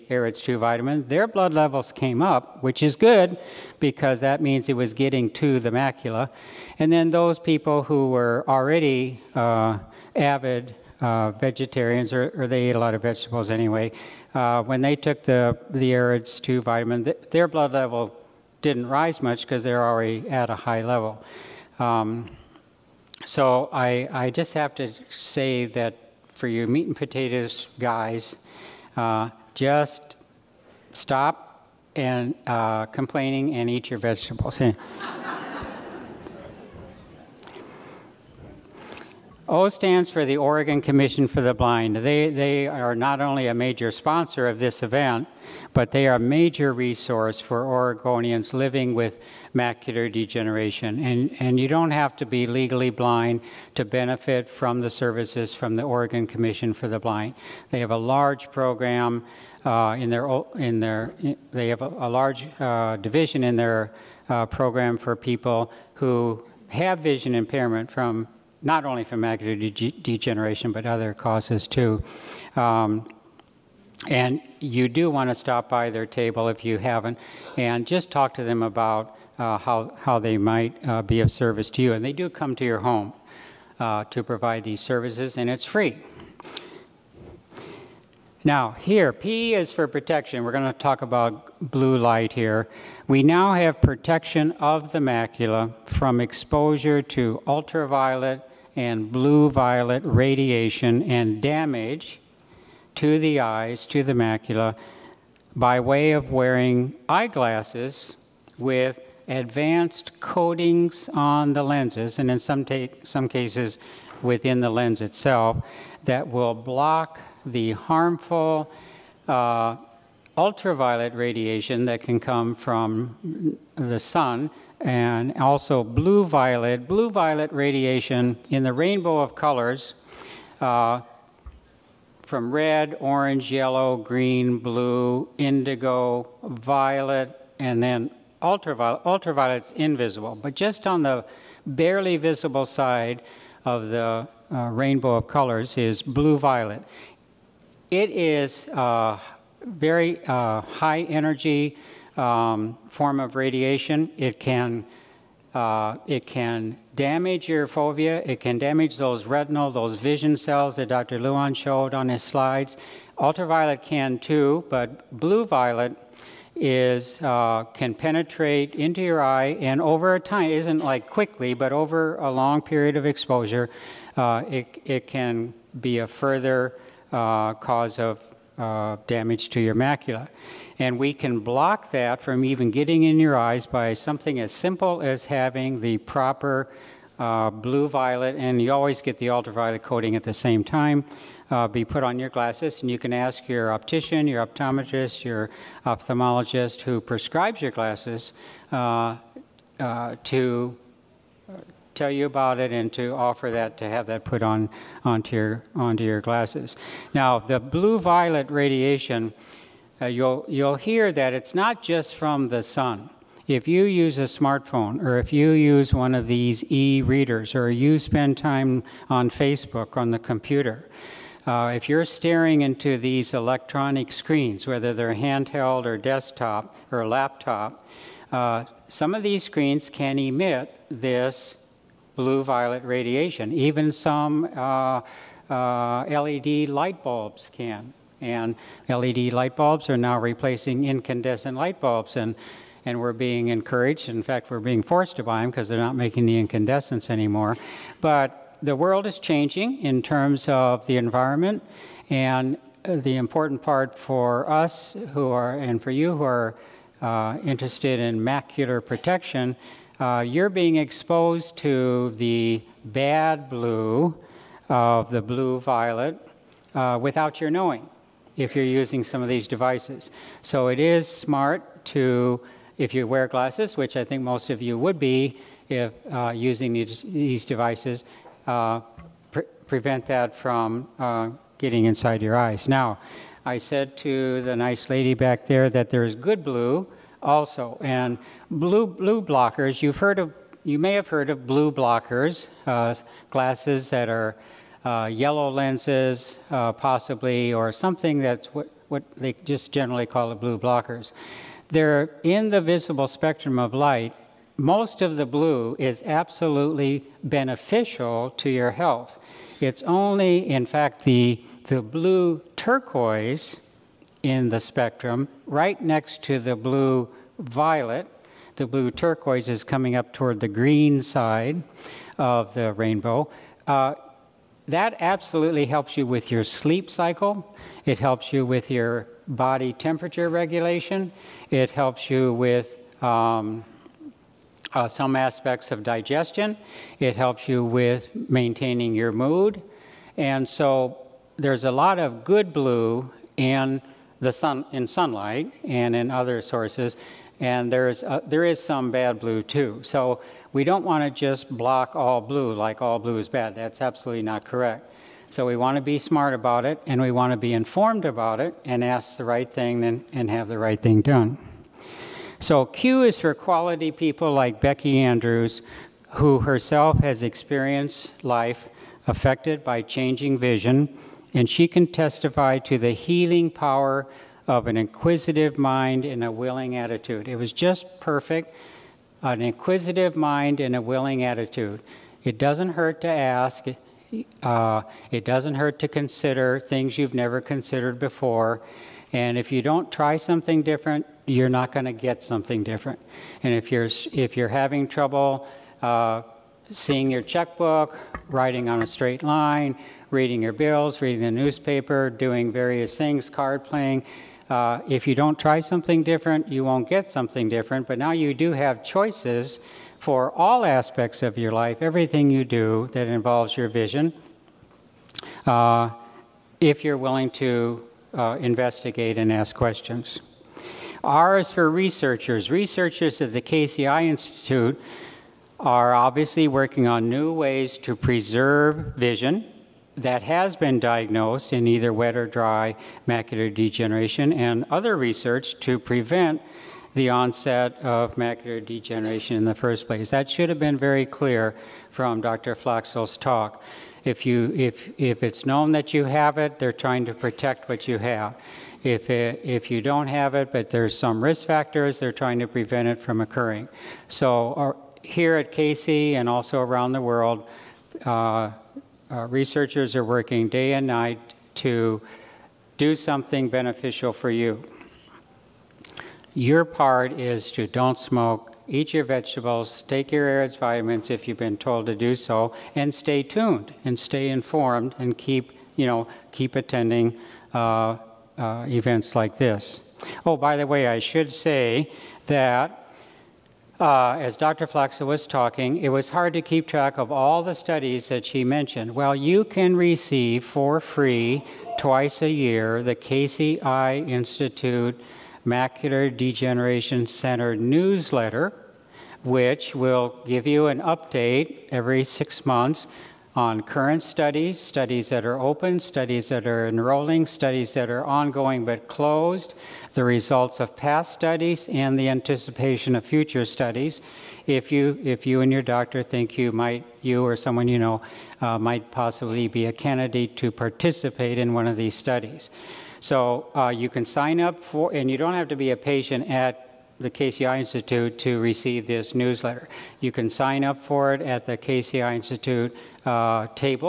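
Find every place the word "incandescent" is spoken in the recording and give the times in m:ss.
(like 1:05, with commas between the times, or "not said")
4:00, 4:06.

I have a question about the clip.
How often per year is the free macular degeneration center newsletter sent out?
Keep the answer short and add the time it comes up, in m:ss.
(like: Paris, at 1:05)
Twice a year, at 8:11.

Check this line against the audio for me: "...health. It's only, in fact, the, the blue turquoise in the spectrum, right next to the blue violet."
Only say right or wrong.
right.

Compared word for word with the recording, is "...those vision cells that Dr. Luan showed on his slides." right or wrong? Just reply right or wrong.
right.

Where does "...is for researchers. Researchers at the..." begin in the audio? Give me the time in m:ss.
7:01.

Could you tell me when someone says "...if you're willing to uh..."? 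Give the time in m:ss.
6:56.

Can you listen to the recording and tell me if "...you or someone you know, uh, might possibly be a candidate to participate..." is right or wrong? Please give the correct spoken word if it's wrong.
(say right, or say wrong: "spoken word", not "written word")
right.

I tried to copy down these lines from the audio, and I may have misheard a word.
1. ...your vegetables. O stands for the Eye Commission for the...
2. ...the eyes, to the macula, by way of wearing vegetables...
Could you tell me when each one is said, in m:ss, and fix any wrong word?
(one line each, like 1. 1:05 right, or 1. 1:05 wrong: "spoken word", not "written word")
1. 0:33 wrong: "Oregon", not "Eye"
2. 1:43 wrong: "eyeglasses", not "vegetables".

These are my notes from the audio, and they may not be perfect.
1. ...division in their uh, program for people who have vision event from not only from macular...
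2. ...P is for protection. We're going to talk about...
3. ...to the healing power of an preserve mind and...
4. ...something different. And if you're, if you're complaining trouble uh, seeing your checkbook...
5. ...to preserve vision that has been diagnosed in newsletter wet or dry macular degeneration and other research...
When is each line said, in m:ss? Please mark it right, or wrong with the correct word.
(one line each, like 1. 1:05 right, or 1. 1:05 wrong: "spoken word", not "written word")
1. 1:02 wrong: "impairment", not "event"
2. 1:29 right
3. 6:12 wrong: "inquisitive", not "preserve"
4. 6:32 wrong: "having", not "complaining"
5. 7:07 wrong: "either", not "newsletter".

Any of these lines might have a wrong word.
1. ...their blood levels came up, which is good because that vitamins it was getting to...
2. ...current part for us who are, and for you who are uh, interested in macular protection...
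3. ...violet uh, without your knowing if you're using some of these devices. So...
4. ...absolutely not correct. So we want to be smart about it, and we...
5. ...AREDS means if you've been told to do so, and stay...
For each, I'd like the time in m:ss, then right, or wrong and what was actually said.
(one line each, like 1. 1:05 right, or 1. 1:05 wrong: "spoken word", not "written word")
1. 0:01 wrong: "means", not "vitamins"
2. 4:13 wrong: "important", not "current"
3. 4:25 right
4. 5:53 right
5. 7:50 wrong: "vitamins", not "means".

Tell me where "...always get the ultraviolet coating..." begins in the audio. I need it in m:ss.
3:08.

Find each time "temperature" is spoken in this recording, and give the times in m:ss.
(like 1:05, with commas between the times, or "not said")
5:29.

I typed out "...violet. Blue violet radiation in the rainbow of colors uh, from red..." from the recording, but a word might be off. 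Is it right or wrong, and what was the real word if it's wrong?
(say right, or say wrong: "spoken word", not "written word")
right.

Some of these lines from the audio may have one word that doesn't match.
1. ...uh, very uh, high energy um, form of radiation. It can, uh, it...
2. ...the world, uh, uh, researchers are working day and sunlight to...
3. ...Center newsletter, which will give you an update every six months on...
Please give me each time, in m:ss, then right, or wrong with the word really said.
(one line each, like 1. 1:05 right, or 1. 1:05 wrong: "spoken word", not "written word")
1. 2:28 right
2. 7:36 wrong: "night", not "sunlight"
3. 8:17 right.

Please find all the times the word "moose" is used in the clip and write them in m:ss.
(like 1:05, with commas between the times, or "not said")
not said.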